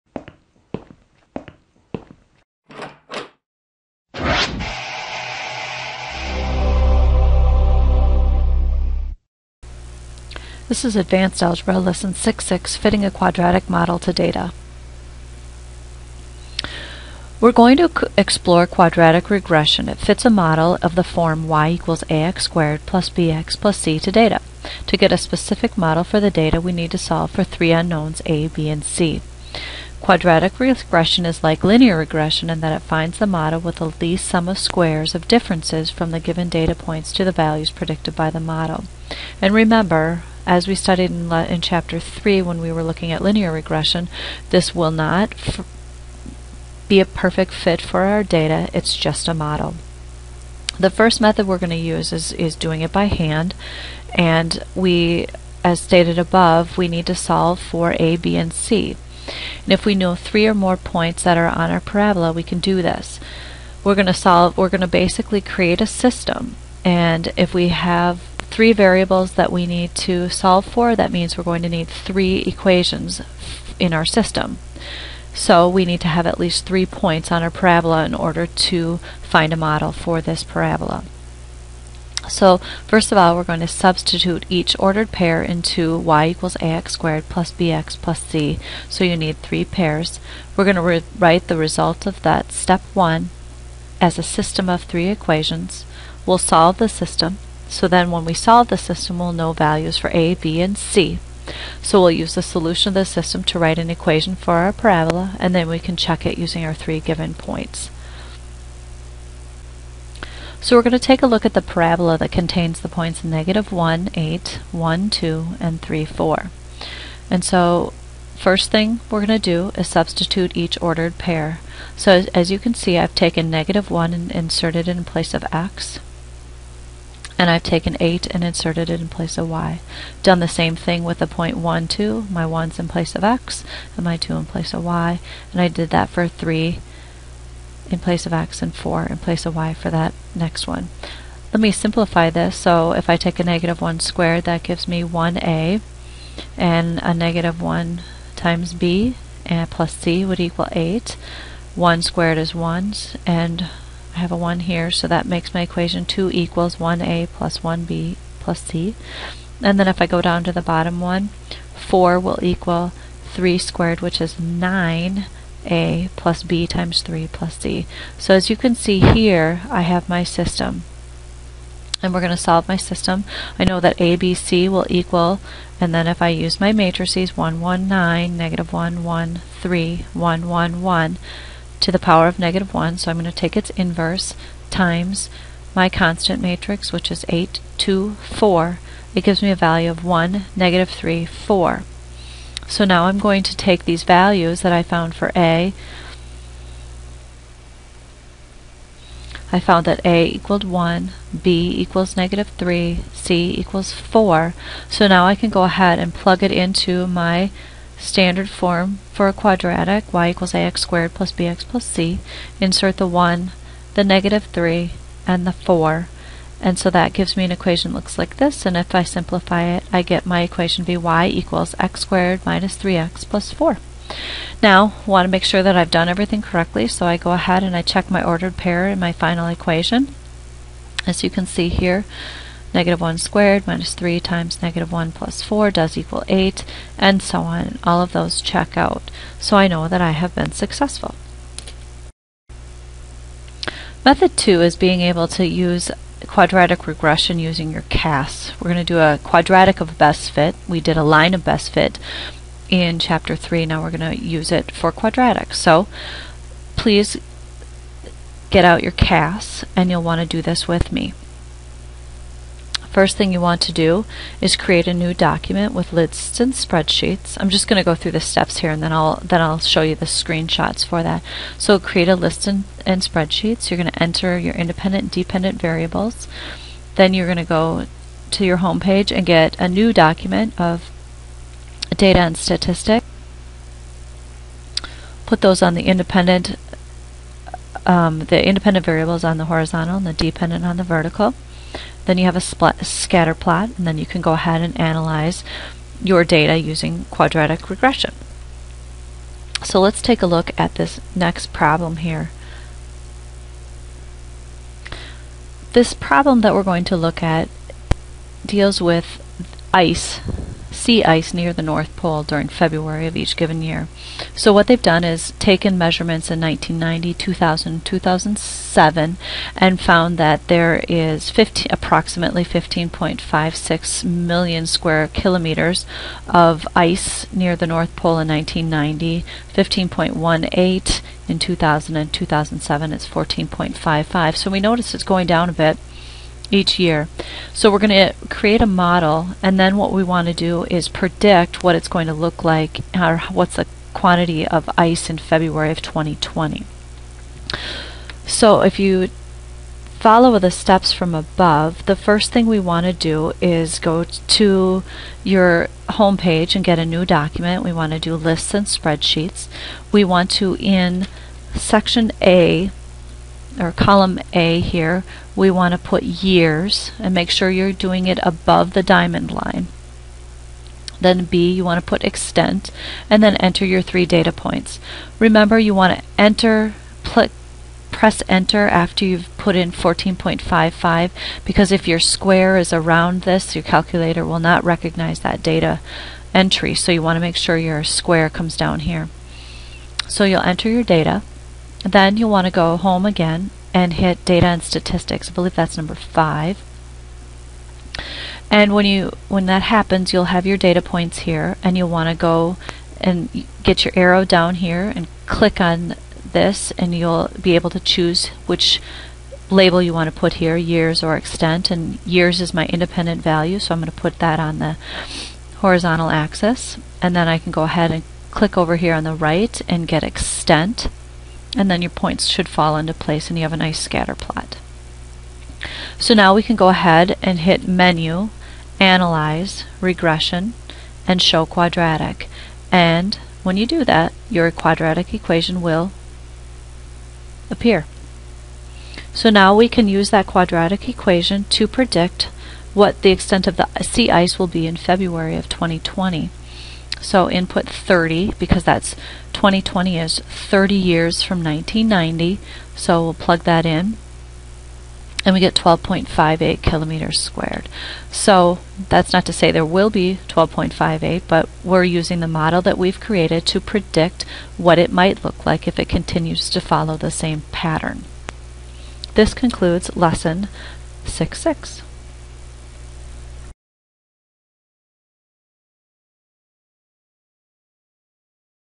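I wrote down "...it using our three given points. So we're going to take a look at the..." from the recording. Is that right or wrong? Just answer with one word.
right.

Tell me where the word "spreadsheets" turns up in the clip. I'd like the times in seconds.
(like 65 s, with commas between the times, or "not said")
266 s, 273 s, 358 s.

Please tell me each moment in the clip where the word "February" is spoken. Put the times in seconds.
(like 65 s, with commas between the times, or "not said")
312 s, 345 s, 444 s.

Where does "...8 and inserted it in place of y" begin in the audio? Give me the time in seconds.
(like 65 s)
127 s.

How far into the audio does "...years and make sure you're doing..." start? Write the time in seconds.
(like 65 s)
366 s.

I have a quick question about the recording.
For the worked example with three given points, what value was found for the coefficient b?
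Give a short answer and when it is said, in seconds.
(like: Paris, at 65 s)
-3, at 201 s.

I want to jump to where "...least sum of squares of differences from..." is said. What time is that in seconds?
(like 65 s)
34 s.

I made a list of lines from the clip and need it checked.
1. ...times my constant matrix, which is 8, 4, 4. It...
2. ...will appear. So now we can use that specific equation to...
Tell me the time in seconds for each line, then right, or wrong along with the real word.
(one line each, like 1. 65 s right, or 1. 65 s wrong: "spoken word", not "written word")
1. 184 s wrong: "2", not "4"
2. 435 s wrong: "quadratic", not "specific".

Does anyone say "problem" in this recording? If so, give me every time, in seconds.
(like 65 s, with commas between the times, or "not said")
301 s, 305 s.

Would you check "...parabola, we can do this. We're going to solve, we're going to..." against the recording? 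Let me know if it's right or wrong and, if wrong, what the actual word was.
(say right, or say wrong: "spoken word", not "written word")
right.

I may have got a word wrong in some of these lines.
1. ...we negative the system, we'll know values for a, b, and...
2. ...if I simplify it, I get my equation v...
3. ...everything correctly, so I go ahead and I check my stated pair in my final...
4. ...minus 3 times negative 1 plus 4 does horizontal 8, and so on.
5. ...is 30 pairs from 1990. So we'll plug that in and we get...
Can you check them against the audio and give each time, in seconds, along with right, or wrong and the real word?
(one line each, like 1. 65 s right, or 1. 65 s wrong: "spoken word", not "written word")
1. 98 s wrong: "solve", not "negative"
2. 218 s right
3. 226 s wrong: "ordered", not "stated"
4. 233 s wrong: "equal", not "horizontal"
5. 449 s wrong: "years", not "pairs".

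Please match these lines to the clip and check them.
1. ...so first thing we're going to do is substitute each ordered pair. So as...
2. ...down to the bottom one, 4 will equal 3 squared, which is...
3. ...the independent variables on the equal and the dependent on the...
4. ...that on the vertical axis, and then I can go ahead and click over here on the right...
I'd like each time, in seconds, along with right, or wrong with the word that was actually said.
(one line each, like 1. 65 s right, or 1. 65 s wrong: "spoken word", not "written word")
1. 117 s right
2. 160 s right
3. 288 s wrong: "horizontal", not "equal"
4. 414 s wrong: "horizontal", not "vertical".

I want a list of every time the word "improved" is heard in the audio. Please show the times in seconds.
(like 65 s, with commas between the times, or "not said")
not said.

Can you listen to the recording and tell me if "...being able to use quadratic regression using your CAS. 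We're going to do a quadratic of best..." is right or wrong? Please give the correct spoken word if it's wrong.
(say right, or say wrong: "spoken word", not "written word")
right.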